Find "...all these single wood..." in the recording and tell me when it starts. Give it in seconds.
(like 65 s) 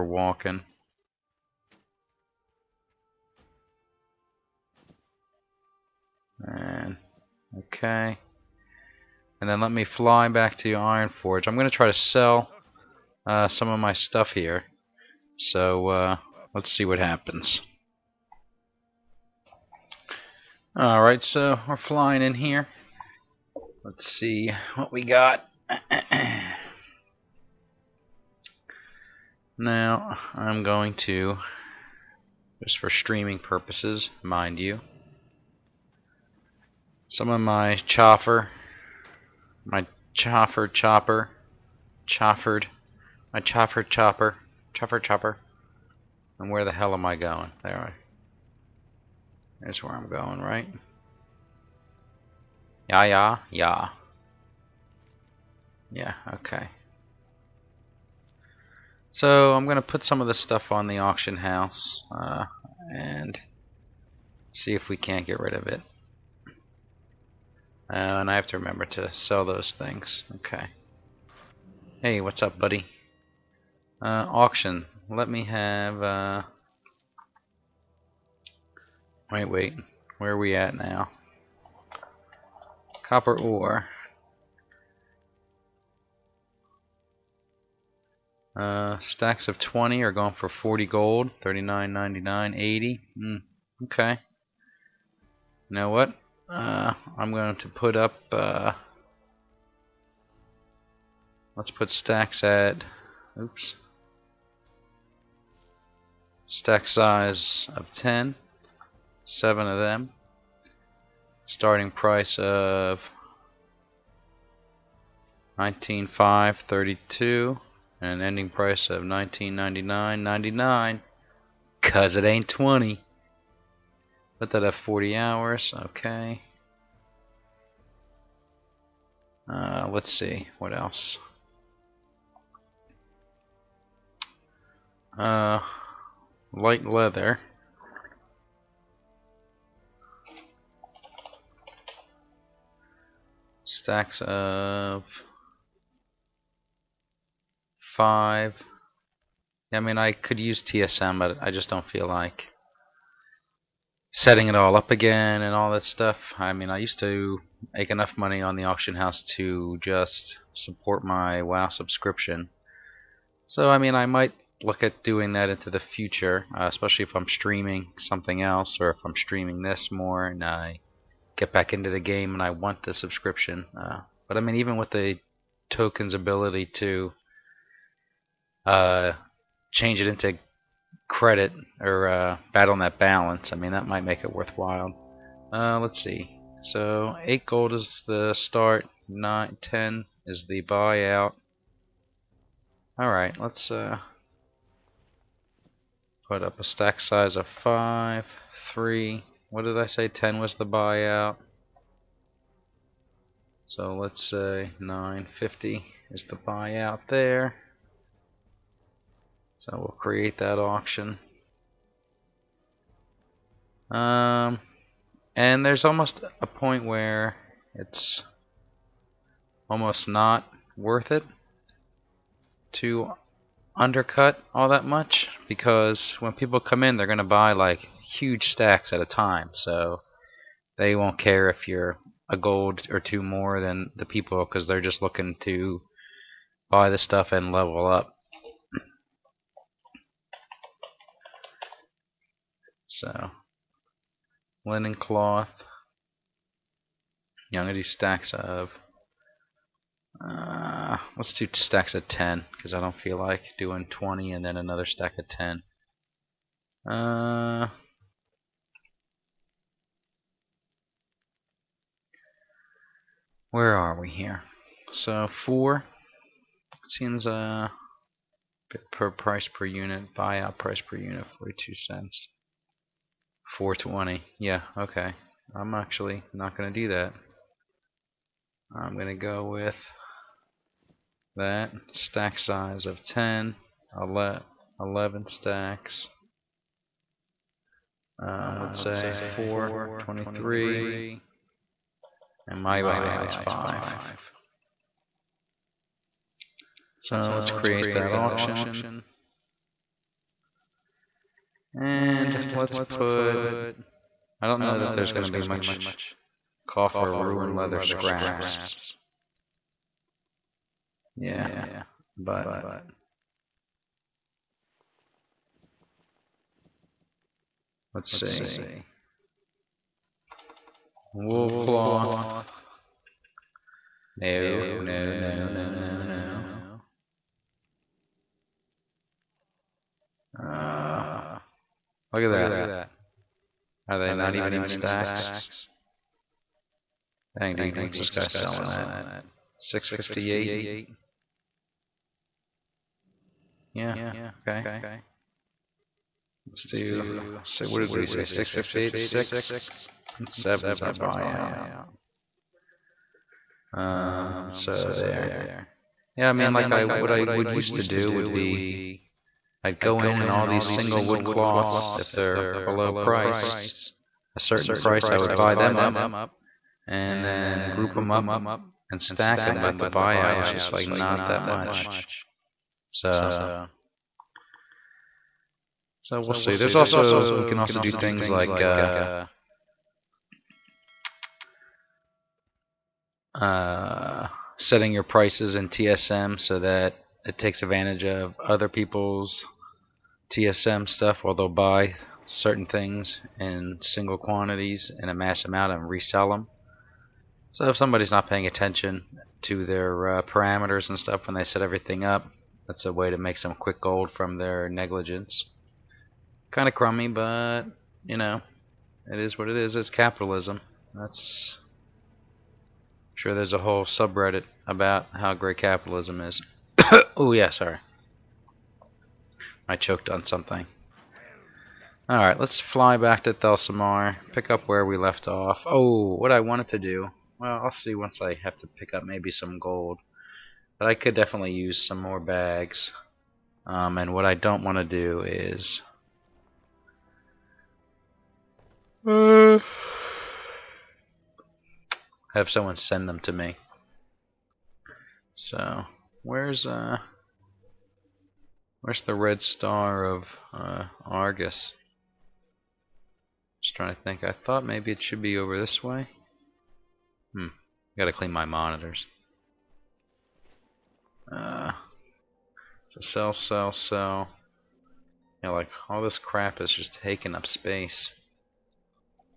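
360 s.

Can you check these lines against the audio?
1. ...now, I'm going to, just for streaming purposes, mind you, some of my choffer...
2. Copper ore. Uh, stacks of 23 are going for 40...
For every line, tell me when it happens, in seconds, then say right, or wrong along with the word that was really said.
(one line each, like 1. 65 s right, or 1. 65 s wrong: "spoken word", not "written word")
1. 29 s right
2. 83 s wrong: "20", not "23".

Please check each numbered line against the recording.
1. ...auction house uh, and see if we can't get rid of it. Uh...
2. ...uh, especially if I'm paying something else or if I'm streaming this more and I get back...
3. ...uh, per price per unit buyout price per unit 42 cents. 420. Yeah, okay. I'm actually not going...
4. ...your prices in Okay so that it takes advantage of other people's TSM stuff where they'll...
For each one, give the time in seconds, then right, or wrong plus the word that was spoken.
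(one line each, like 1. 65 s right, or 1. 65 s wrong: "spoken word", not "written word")
1. 60 s right
2. 166 s wrong: "streaming", not "paying"
3. 267 s right
4. 384 s wrong: "TSM", not "Okay".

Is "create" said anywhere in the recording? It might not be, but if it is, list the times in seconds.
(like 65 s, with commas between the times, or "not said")
209 s, 297 s.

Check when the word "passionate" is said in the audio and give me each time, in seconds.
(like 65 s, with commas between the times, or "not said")
not said.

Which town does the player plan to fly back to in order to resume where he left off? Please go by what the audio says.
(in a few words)
Thelsamar.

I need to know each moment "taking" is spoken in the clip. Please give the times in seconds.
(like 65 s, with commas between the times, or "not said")
467 s.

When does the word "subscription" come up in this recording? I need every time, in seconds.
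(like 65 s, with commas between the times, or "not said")
161 s, 172 s.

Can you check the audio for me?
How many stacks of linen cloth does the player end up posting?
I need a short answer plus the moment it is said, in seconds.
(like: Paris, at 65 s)
11, at 283 s.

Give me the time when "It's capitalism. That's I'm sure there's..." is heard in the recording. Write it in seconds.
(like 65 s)
409 s.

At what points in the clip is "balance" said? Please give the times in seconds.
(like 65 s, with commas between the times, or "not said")
182 s.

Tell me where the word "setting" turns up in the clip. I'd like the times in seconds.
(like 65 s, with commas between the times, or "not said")
154 s, 384 s.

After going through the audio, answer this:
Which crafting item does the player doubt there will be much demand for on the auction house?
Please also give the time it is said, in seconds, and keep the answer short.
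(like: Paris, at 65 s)
Ruined leather scraps, at 307 s.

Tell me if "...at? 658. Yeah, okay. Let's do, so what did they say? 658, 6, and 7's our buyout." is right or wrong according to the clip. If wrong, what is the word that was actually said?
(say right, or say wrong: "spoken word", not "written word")
right.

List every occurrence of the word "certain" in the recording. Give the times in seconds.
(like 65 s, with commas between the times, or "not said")
364 s, 392 s.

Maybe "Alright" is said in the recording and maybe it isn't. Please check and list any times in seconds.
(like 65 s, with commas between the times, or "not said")
20 s, 192 s, 422 s.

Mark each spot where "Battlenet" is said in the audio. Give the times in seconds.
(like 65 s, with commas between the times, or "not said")
182 s.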